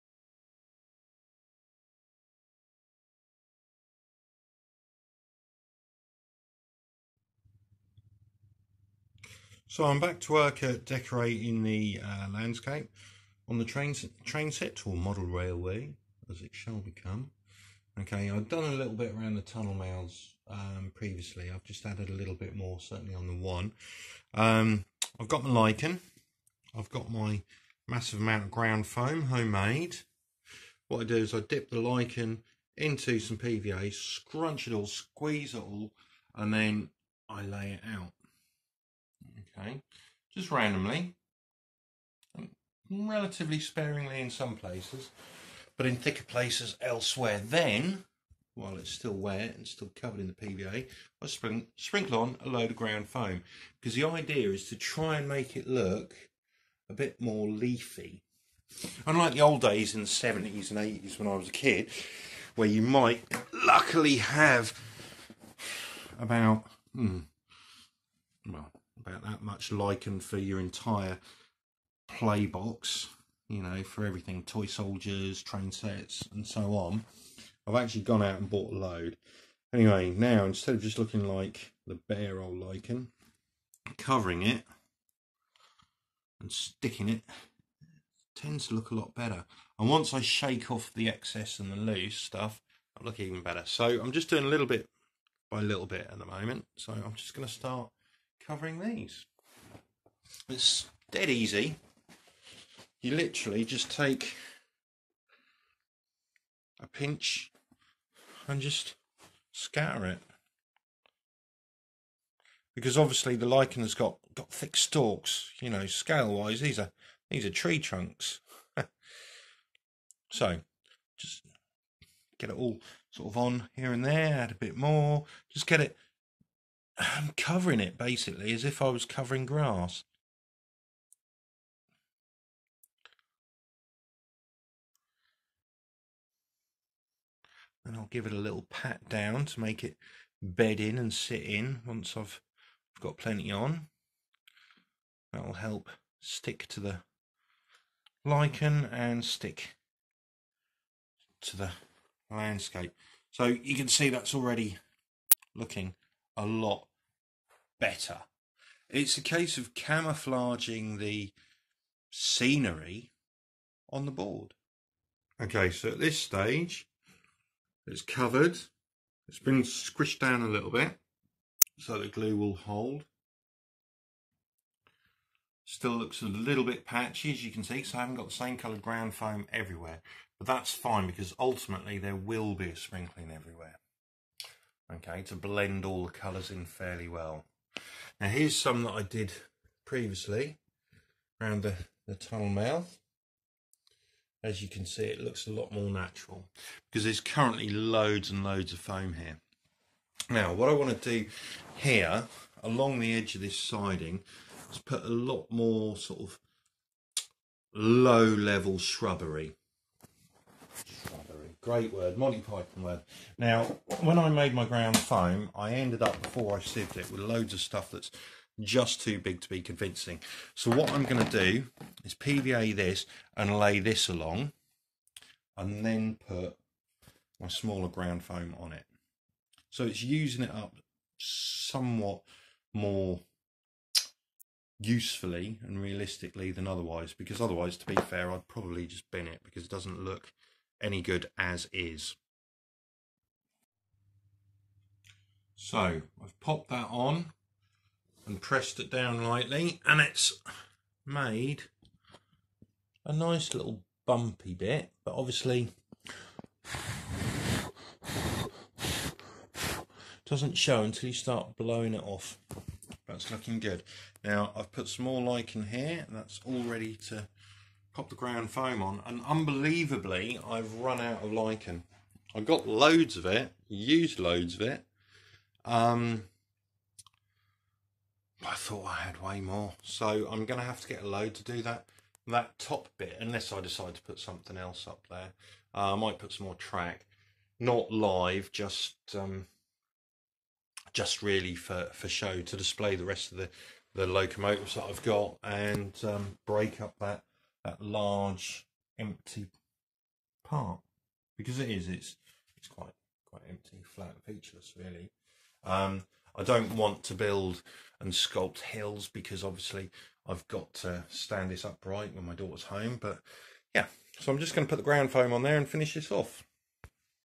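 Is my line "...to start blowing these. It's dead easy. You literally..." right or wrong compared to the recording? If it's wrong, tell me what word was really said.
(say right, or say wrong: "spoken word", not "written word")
wrong: "covering", not "blowing".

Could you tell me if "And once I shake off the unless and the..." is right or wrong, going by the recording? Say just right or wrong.
wrong.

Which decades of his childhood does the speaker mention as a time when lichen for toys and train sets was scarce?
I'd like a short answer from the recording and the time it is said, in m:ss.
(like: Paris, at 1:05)
70s and 80s, at 1:00.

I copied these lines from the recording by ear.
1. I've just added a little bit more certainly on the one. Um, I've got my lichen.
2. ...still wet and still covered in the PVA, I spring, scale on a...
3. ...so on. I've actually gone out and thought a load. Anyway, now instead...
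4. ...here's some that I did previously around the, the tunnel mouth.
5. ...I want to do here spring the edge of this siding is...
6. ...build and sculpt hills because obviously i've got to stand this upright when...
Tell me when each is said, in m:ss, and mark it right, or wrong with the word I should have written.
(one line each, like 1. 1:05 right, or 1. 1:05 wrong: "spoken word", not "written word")
1. 0:21 right
2. 0:48 wrong: "sprinkle", not "scale"
3. 1:16 wrong: "bought", not "thought"
4. 3:08 right
5. 3:20 wrong: "along", not "spring"
6. 5:07 right.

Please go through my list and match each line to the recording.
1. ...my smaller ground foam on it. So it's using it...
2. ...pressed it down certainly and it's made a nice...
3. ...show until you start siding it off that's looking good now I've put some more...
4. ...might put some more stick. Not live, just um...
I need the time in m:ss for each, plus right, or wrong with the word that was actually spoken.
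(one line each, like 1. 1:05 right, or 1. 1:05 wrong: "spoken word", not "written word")
1. 3:47 right
2. 4:08 wrong: "lightly", not "certainly"
3. 4:20 wrong: "blowing", not "siding"
4. 4:45 wrong: "track", not "stick".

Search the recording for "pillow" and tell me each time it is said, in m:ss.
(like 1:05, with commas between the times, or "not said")
not said.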